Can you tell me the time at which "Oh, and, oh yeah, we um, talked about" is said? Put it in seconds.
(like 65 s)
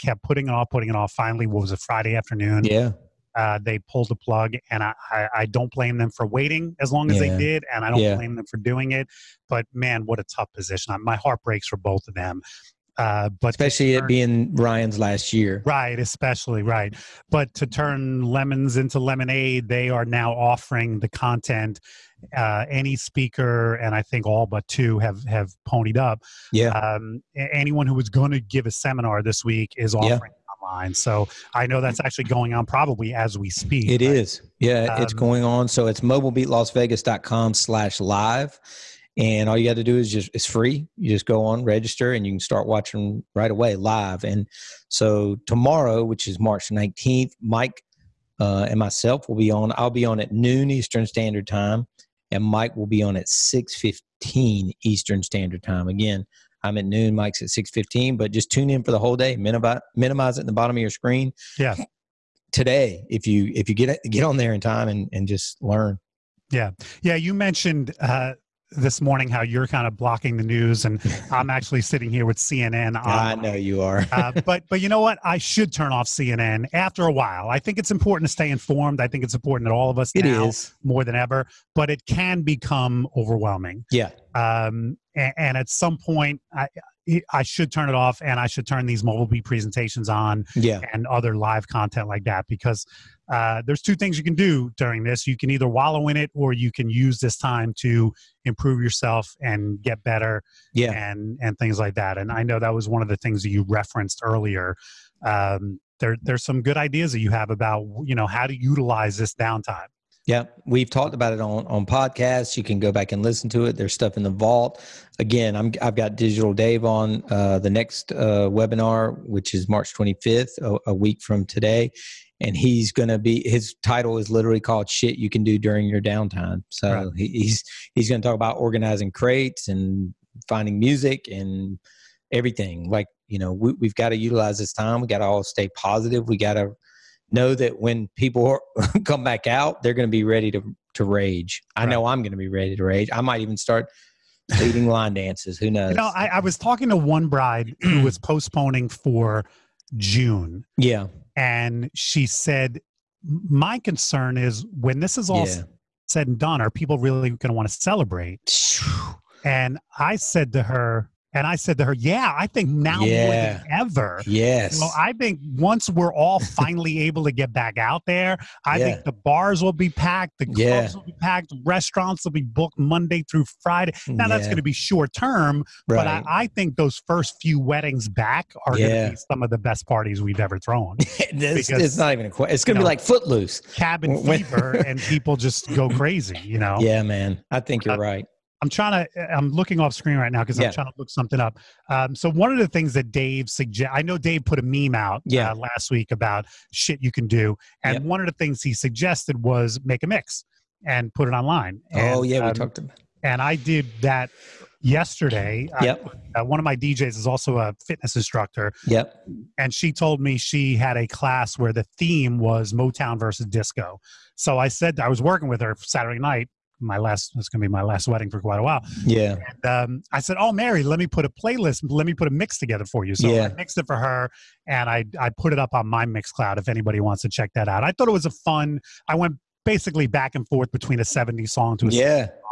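201 s.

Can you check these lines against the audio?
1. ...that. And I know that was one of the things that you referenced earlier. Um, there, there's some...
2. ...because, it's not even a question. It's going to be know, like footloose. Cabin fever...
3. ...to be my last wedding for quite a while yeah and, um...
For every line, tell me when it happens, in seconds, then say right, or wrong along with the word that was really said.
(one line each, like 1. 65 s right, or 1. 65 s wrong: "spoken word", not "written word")
1. 101 s right
2. 181 s right
3. 217 s right.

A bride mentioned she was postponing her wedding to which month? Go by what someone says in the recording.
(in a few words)
June.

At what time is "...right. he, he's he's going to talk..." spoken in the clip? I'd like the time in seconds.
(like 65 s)
127 s.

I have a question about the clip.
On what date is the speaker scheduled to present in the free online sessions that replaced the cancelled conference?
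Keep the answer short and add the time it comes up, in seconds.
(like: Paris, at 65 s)
March 19th, at 46 s.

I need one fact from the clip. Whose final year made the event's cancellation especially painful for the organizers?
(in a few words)
Ryan.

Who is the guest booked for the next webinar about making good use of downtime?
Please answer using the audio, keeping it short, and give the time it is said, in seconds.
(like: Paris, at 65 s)
Digital Dave, at 116 s.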